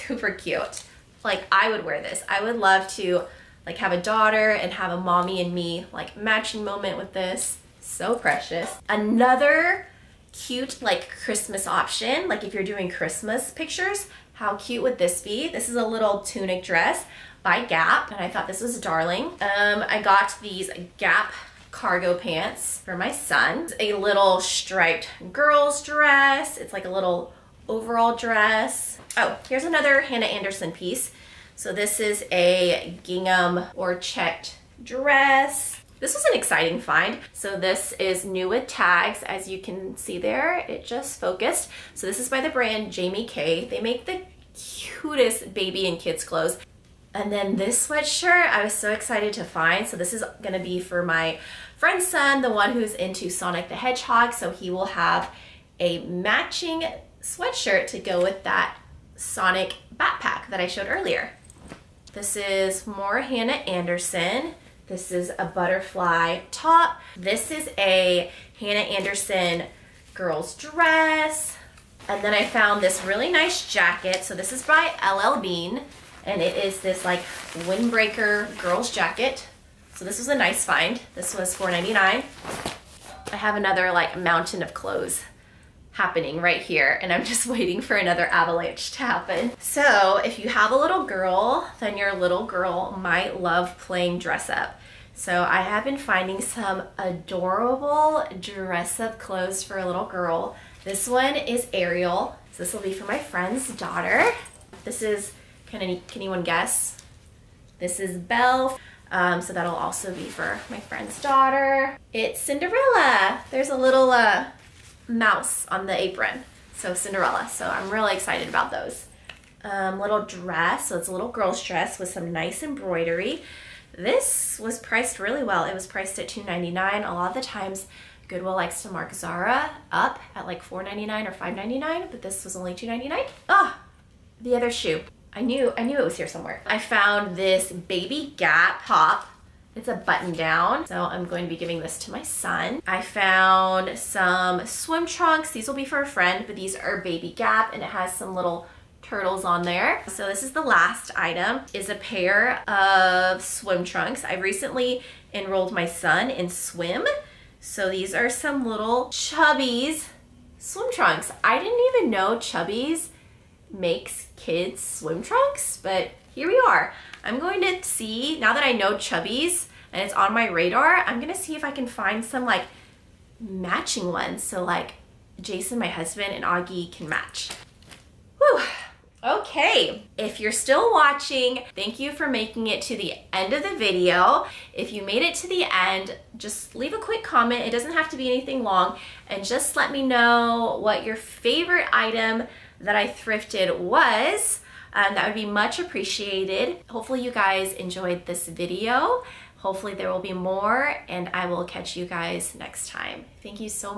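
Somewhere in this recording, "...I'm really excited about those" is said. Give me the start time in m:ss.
1:57.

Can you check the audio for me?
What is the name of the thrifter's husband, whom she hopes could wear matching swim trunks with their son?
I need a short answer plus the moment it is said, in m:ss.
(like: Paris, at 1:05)
Jason, at 2:55.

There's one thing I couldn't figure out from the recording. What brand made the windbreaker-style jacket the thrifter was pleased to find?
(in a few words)
LL Bean.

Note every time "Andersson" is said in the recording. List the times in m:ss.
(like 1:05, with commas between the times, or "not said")
0:30, 1:03, 1:08.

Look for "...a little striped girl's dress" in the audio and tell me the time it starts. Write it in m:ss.
0:23.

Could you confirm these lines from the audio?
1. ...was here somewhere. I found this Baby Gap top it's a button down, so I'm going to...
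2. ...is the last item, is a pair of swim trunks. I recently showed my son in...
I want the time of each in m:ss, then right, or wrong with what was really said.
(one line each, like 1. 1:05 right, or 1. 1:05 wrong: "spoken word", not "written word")
1. 2:16 right
2. 2:30 wrong: "enrolled", not "showed".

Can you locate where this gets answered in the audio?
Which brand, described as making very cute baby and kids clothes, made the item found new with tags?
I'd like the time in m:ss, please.
0:42.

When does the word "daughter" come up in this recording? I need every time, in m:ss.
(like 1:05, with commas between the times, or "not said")
0:04, 1:43, 1:51.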